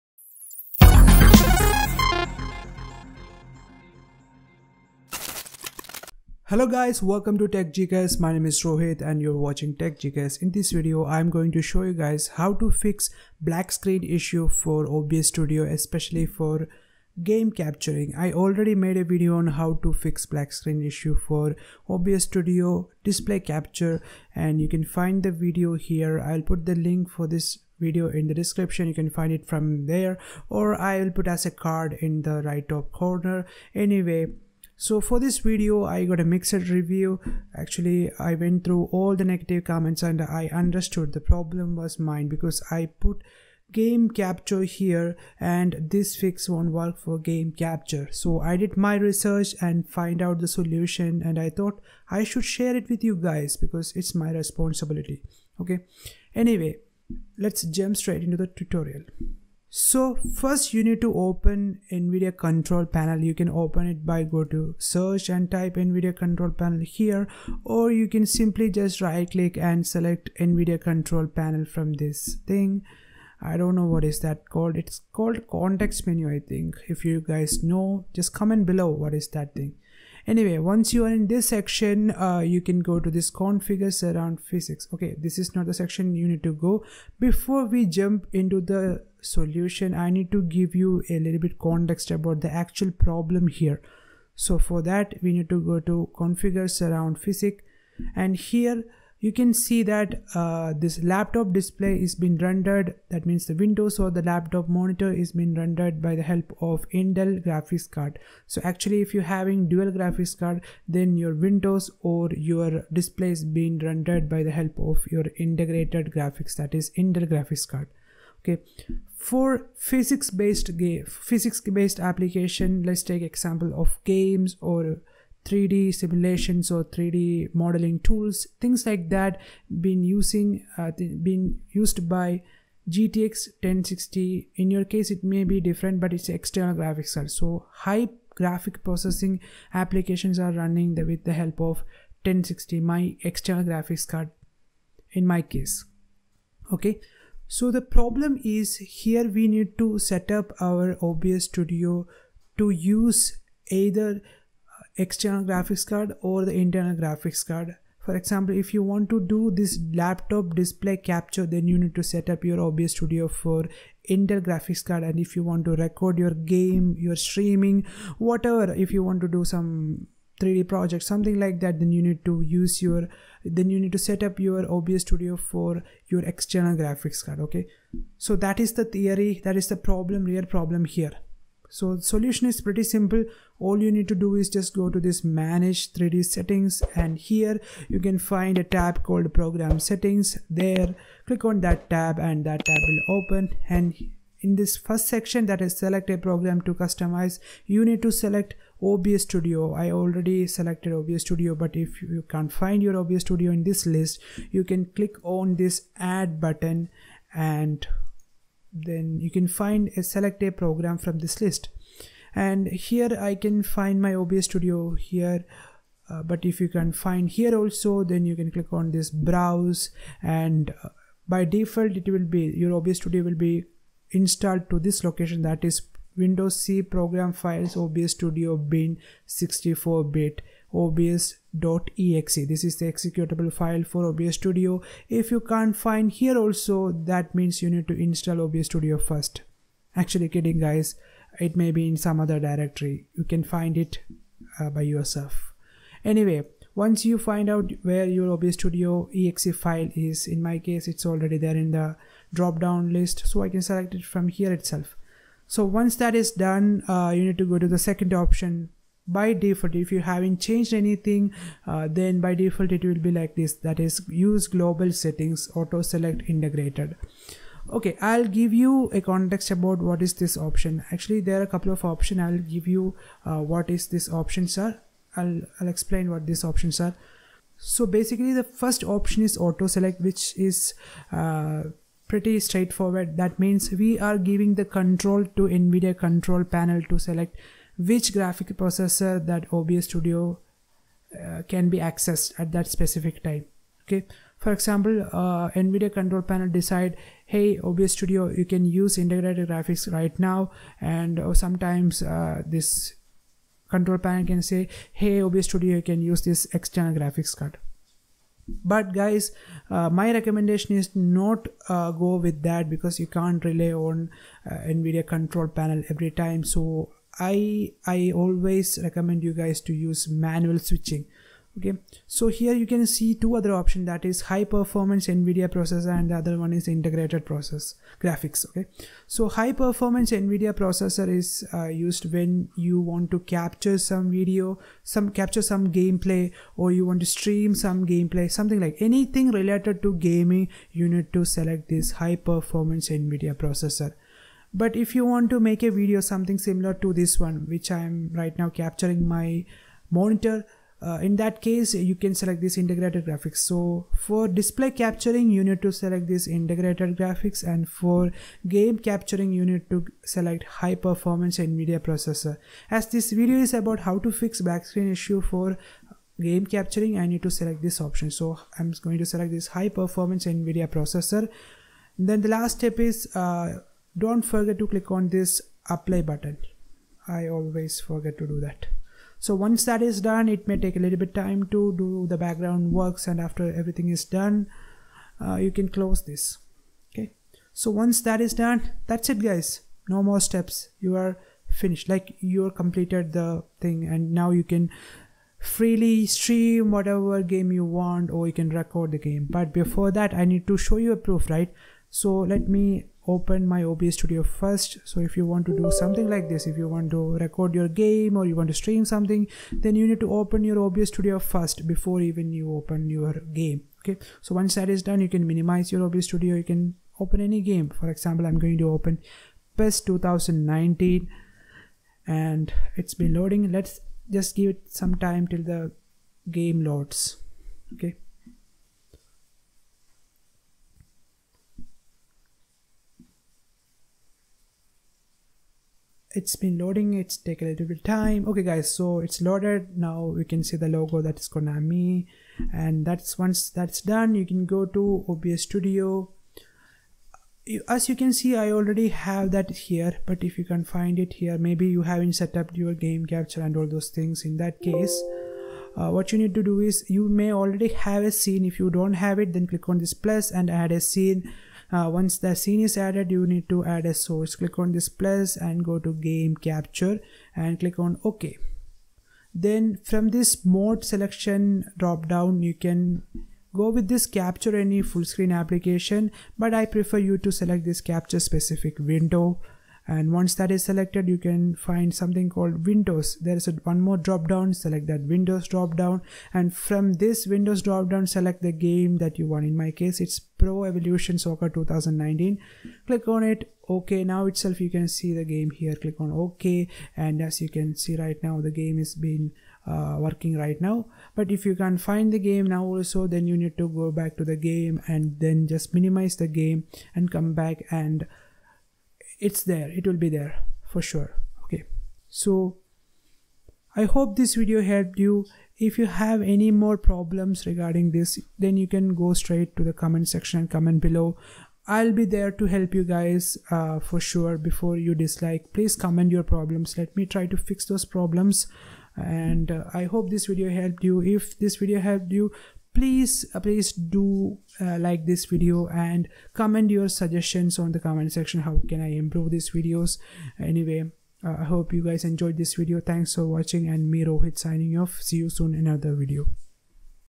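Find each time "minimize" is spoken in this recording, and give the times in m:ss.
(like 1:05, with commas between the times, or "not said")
6:55, 8:25.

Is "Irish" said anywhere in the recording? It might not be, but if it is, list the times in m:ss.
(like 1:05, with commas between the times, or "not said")
not said.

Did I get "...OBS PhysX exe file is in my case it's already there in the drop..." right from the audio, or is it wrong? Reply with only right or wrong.
wrong.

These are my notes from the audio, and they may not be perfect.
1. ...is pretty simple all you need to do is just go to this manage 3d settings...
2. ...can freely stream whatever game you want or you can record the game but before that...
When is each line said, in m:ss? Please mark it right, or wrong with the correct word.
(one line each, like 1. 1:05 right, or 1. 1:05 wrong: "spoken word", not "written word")
1. 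3:02 right
2. 6:34 right.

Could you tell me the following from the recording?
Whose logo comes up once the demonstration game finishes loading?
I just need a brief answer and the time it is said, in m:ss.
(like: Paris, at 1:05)
Konami, at 7:21.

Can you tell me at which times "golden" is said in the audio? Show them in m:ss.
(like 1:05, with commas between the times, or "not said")
not said.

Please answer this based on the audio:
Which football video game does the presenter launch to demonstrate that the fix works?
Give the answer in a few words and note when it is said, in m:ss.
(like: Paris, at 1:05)
PES 2019, at 6:59.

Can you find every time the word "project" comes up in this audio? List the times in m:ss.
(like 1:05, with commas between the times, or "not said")
2:50.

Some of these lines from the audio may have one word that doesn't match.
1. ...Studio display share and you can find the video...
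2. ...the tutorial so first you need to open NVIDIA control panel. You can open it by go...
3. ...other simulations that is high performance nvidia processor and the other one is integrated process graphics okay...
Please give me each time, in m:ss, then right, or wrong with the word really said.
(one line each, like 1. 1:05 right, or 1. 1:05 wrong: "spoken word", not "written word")
1. 0:22 wrong: "capture", not "share"
2. 0:58 right
3. 5:23 wrong: "options", not "simulations".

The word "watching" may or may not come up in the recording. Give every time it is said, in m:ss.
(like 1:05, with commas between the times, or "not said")
0:09, 9:03.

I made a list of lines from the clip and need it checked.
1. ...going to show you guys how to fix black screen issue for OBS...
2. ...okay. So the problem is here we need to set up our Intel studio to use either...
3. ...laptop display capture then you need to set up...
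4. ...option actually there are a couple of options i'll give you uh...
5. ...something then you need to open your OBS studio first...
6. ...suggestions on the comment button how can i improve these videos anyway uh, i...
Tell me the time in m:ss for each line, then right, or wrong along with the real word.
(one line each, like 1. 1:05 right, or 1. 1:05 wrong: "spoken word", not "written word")
1. 0:11 right
2. 2:26 wrong: "OBS", not "Intel"
3. 2:39 right
4. 4:30 right
5. 6:48 right
6. 8:56 wrong: "section", not "button".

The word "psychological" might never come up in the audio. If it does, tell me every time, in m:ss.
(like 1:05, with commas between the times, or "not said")
not said.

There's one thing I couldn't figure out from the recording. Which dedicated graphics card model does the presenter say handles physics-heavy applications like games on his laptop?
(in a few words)
GTX 1060.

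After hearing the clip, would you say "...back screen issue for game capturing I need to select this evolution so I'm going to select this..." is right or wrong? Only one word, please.
wrong.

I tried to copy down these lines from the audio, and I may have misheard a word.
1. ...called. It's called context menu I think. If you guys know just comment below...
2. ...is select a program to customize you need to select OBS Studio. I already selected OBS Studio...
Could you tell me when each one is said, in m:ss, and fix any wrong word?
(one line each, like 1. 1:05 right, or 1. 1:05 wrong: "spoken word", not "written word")
1. 1:14 right
2. 3:15 right.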